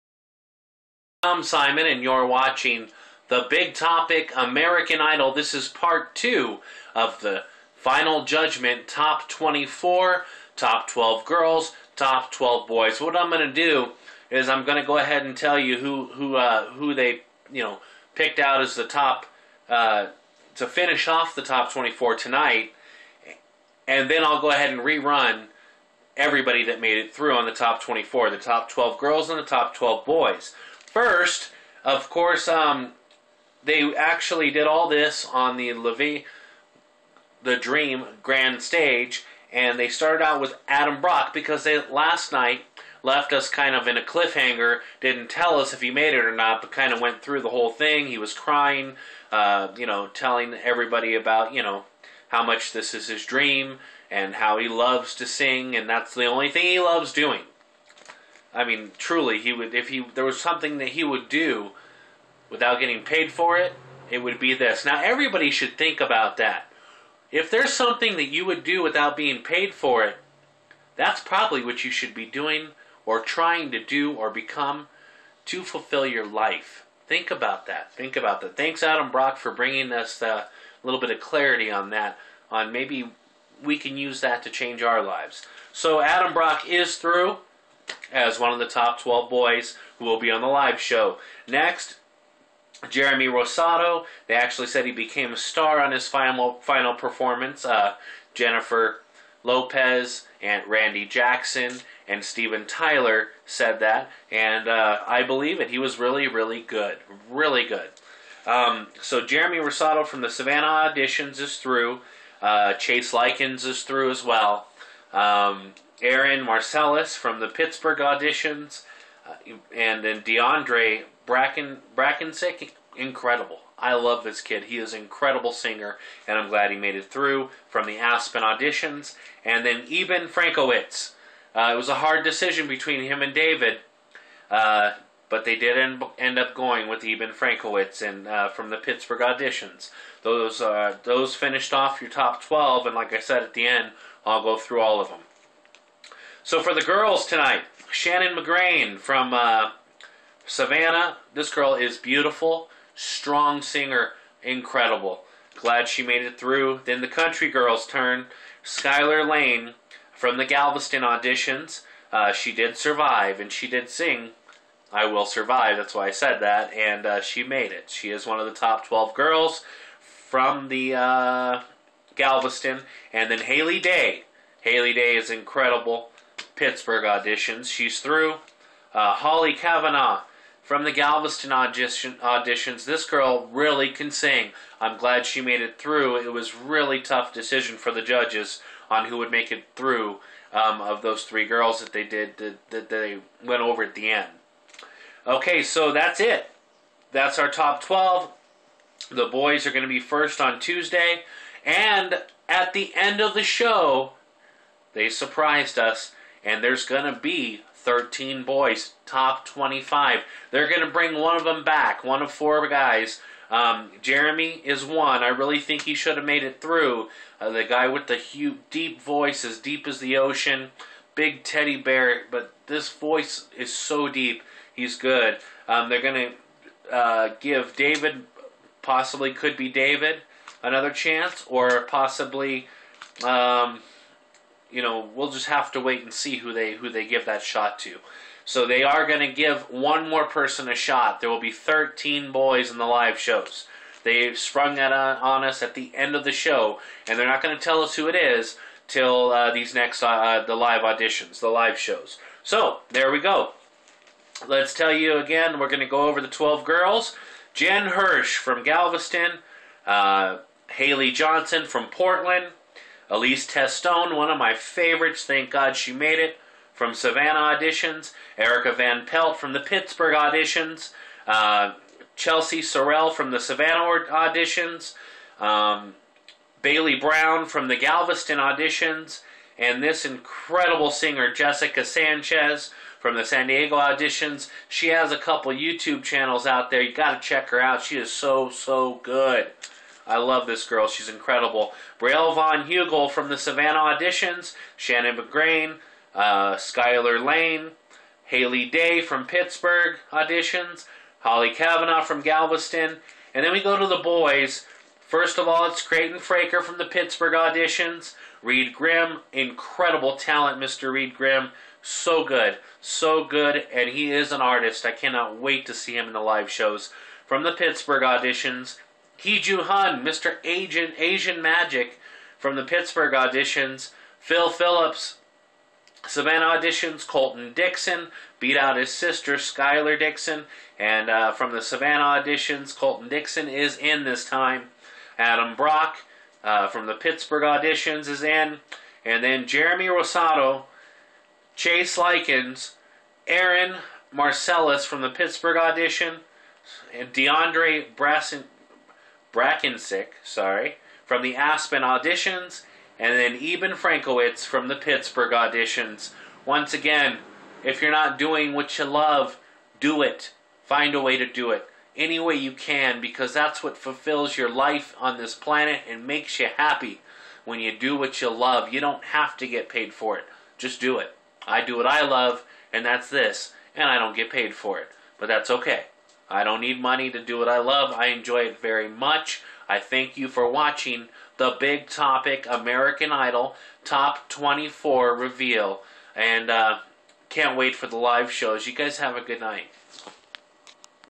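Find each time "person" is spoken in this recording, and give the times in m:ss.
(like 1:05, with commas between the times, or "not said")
4:00.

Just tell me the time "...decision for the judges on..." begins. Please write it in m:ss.
3:07.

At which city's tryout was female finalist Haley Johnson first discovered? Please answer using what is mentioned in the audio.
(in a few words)
Portland.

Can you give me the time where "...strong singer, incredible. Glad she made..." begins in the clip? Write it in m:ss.
2:32.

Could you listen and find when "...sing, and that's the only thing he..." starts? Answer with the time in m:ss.
0:55.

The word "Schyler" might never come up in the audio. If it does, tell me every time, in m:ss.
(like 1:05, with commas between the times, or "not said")
5:29.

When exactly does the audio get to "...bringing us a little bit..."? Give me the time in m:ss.
1:19.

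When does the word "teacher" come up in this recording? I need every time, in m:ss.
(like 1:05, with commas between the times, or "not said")
not said.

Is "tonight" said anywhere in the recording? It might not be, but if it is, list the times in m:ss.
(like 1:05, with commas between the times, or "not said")
0:22, 2:27.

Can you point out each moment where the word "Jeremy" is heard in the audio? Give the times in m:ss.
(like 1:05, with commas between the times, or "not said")
1:32, 1:49, 3:34, 5:39.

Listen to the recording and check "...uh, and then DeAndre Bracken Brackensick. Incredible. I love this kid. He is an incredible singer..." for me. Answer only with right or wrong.
right.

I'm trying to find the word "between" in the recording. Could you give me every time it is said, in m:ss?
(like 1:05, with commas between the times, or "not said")
2:12.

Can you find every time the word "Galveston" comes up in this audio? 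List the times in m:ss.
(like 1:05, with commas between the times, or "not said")
2:40, 2:52, 3:00, 4:18, 4:37, 5:02.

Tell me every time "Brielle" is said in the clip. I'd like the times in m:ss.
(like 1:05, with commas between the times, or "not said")
4:51.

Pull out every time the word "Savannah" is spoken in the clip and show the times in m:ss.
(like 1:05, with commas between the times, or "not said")
1:50, 2:30, 4:26, 4:33, 4:53, 5:26, 5:31.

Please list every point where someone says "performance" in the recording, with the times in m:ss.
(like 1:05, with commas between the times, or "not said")
1:36.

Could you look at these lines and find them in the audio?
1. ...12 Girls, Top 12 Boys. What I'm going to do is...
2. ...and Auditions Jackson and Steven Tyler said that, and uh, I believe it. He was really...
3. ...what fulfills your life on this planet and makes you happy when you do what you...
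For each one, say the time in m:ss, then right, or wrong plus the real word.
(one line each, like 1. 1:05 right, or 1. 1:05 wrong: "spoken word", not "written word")
1. 0:10 right
2. 1:40 wrong: "Randy", not "Auditions"
3. 6:03 right.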